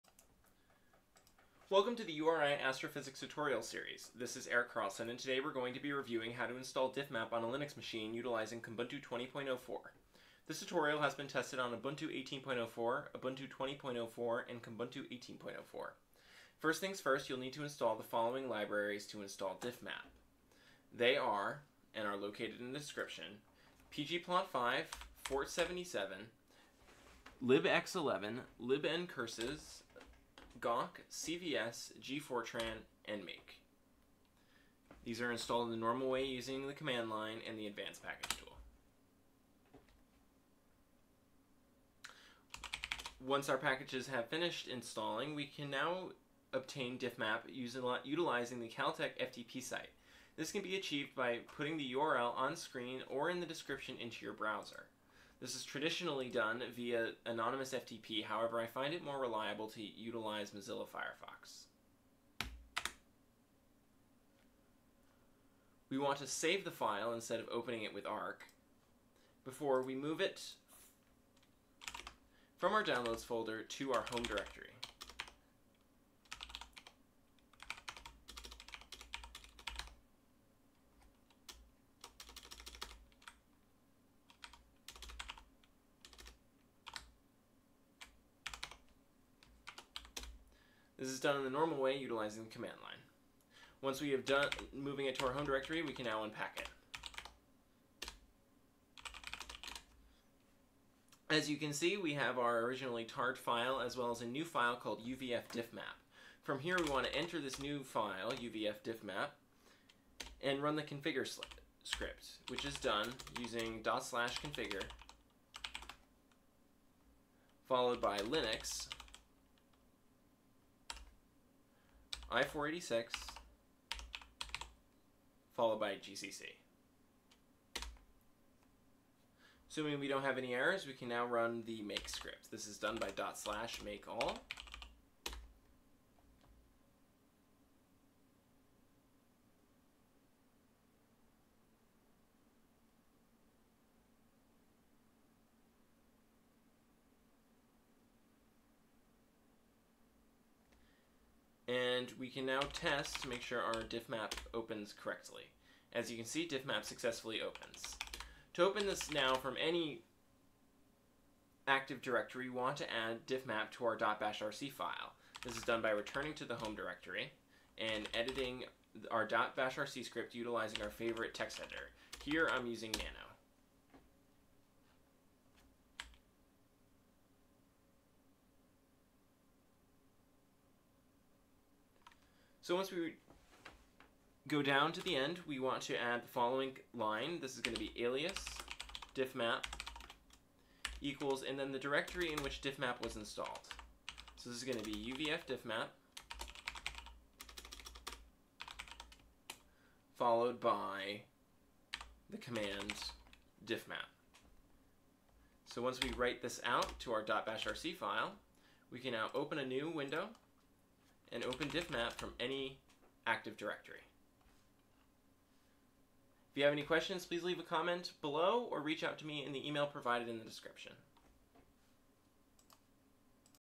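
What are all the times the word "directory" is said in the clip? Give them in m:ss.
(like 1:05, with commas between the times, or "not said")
1:14, 1:35, 2:42, 2:46, 3:11, 3:33.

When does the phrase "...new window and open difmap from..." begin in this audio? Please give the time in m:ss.
3:29.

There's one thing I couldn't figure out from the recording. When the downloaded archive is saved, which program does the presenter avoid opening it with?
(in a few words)
Ark.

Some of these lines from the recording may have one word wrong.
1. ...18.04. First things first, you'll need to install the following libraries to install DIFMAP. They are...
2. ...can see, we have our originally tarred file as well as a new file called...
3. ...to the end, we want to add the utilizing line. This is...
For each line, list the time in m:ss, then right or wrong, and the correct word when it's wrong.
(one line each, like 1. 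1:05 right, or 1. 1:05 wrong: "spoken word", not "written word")
1. 0:15 right
2. 1:41 right
3. 3:04 wrong: "following", not "utilizing".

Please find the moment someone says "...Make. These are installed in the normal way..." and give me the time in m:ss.
0:33.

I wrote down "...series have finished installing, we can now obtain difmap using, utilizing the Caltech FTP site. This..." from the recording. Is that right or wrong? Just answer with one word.
wrong.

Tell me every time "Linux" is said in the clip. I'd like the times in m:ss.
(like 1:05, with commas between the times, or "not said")
0:07, 1:58.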